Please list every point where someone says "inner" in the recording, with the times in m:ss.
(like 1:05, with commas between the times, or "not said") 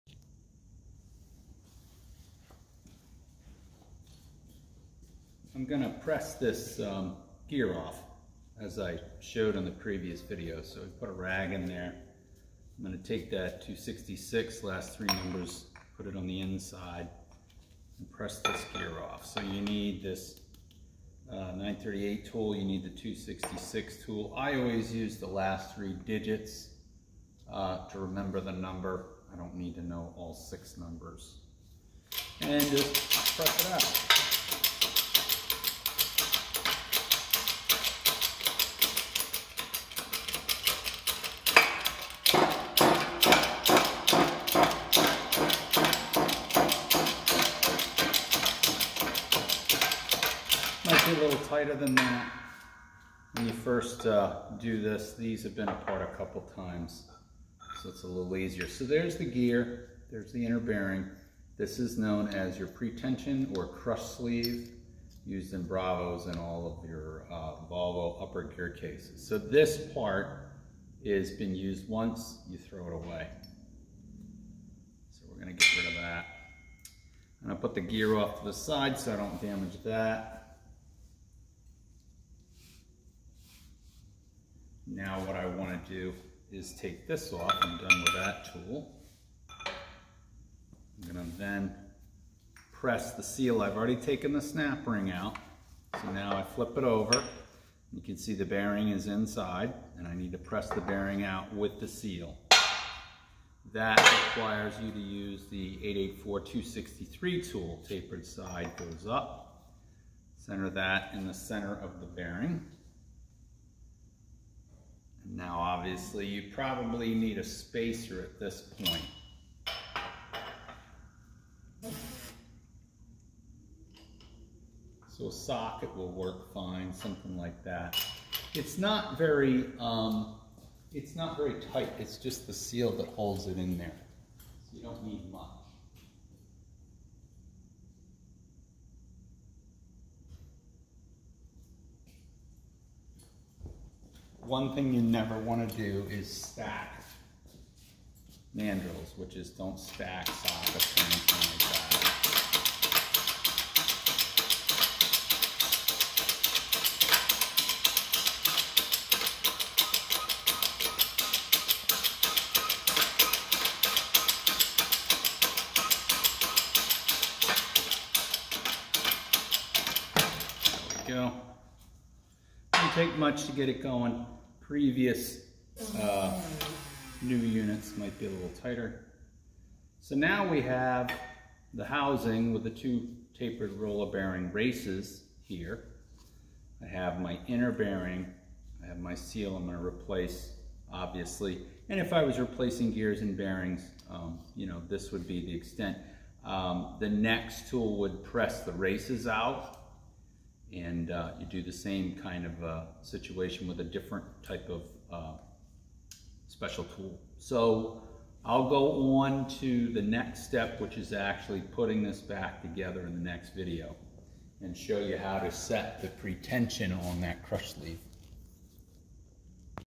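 1:00, 3:07.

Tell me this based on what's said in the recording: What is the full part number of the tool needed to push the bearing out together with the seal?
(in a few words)
884-263.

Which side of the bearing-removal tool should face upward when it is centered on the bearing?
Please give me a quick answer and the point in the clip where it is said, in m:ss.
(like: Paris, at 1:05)
Tapered side, at 1:47.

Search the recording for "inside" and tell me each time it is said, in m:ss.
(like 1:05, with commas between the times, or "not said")
0:16, 1:39.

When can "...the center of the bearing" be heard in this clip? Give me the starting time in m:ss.
1:51.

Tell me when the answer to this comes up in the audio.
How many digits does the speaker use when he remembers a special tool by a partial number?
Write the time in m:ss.
0:25.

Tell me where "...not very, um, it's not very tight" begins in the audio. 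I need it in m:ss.
2:08.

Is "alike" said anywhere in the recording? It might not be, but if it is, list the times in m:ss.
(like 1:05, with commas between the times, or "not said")
not said.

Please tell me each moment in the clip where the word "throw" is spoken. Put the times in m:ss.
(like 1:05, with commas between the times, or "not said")
1:12.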